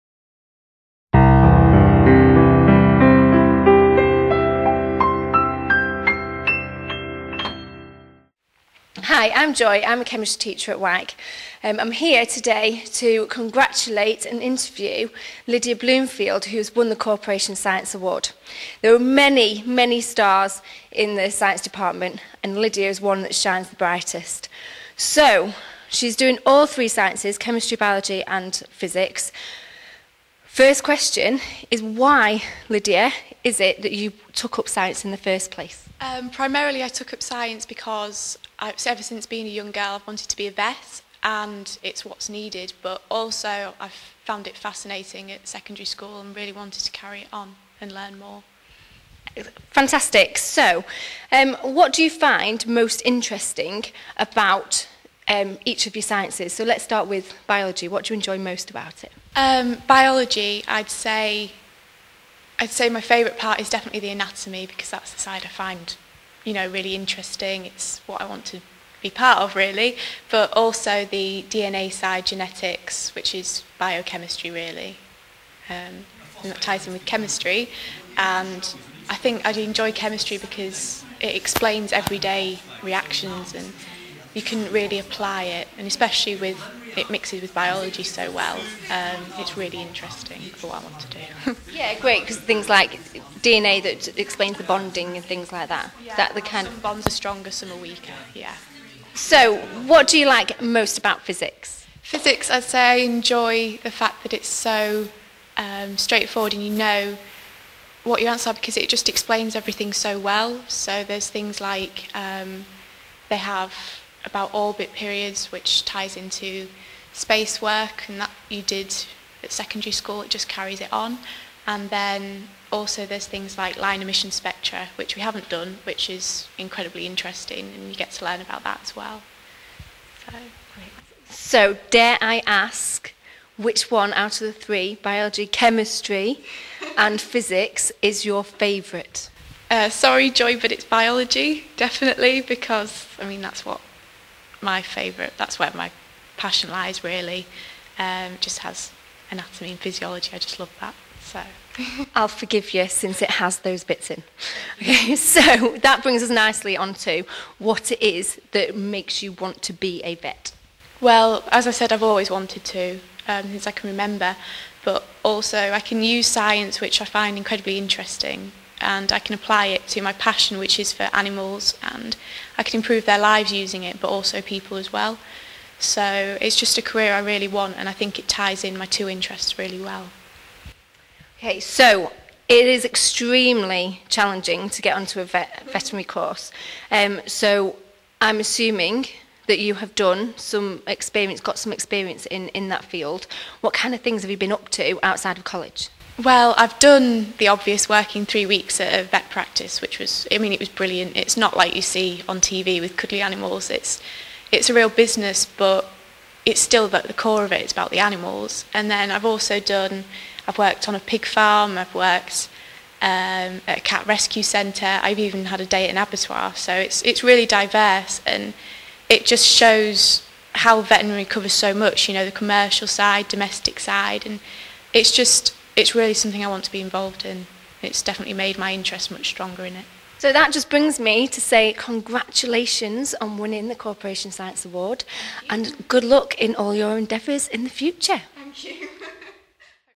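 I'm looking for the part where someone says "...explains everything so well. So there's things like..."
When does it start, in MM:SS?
01:49.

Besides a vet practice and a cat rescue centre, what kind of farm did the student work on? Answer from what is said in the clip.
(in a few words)
Pig farm.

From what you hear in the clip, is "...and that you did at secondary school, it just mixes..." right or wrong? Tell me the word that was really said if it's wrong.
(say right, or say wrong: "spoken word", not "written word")
wrong: "carries", not "mixes".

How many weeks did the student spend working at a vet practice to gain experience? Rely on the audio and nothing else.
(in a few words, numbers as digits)
3.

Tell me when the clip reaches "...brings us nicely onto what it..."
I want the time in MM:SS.
02:36.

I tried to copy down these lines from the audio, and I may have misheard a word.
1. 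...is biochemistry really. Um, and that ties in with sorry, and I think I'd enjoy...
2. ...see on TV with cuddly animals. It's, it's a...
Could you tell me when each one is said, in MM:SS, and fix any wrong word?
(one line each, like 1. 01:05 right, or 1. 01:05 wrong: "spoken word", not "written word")
1. 01:13 wrong: "chemistry", not "sorry"
2. 03:21 right.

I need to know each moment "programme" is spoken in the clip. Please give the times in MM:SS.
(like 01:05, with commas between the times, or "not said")
not said.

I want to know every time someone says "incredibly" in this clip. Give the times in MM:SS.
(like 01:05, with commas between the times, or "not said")
02:06, 02:47.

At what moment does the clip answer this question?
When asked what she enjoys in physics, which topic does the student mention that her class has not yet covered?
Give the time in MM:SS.
02:03.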